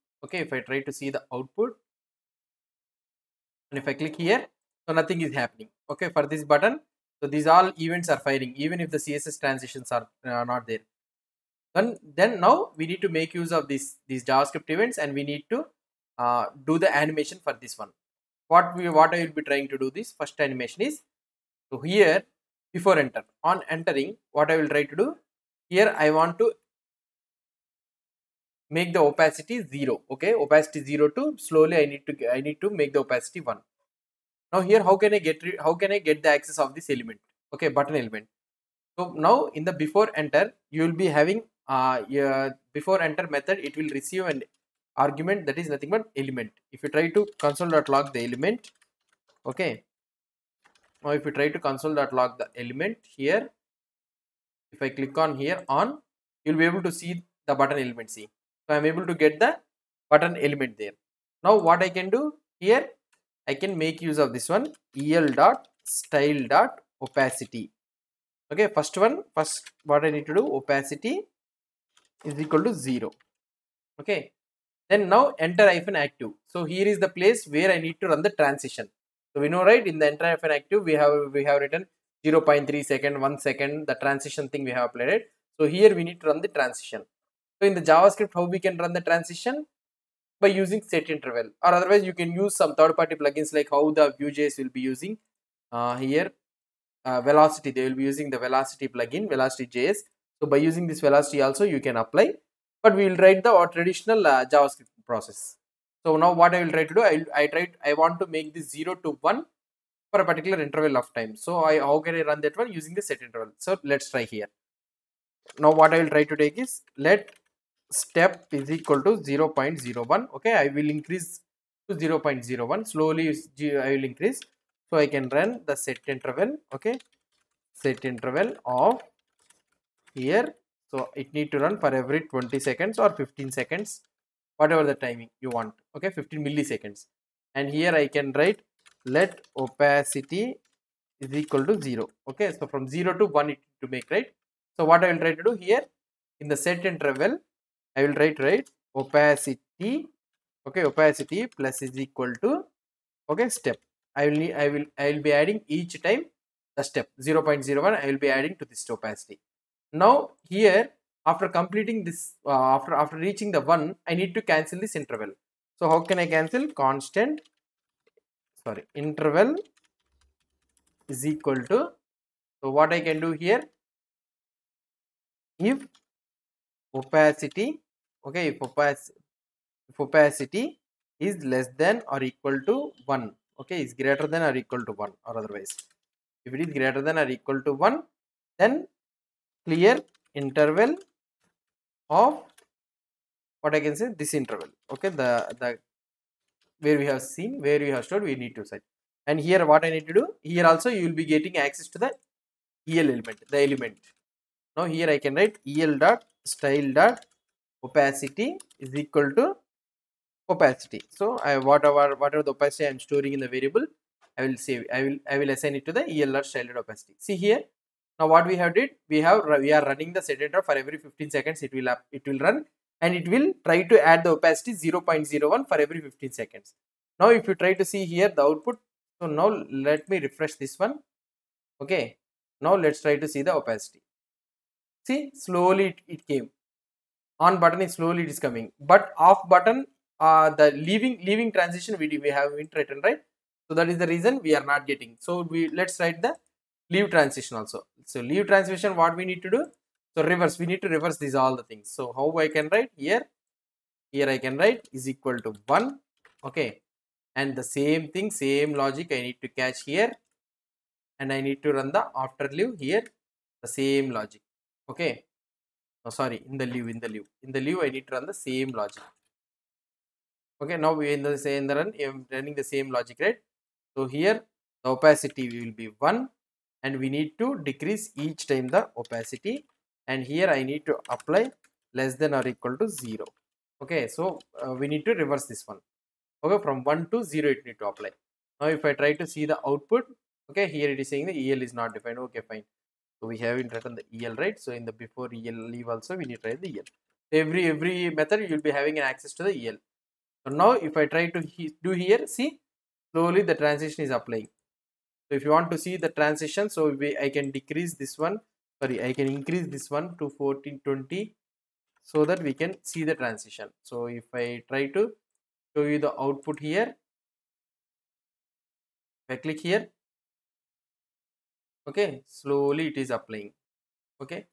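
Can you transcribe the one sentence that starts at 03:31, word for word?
So I whatever whatever the opacity I am storing in the variable, I will save.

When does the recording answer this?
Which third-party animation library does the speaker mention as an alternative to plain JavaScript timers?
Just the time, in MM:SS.
01:39.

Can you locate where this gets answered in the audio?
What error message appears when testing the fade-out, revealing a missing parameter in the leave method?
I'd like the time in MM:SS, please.
04:51.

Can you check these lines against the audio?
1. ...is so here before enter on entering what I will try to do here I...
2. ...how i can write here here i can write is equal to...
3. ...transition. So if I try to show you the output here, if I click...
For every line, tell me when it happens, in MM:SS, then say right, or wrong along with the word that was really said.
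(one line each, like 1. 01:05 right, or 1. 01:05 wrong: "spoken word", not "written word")
1. 00:20 right
2. 04:12 right
3. 05:13 right.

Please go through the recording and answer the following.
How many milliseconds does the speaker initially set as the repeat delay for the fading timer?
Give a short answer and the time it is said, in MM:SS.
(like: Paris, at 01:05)
15, at 02:16.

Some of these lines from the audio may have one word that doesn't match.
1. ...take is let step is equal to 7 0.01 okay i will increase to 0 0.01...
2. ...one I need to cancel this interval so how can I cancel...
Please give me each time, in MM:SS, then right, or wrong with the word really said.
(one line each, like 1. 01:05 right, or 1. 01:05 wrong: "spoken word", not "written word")
1. 01:56 wrong: "0", not "7"
2. 02:43 right.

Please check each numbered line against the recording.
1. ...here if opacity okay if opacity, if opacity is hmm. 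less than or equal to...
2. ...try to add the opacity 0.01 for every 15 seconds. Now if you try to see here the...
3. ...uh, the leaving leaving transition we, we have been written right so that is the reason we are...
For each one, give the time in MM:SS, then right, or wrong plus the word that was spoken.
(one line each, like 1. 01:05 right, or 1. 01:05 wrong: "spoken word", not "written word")
1. 02:53 right
2. 03:43 right
3. 04:00 right.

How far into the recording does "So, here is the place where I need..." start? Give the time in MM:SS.
01:16.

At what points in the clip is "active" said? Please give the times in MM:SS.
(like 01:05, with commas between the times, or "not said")
01:15, 01:20.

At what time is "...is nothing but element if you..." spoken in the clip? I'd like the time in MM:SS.
00:45.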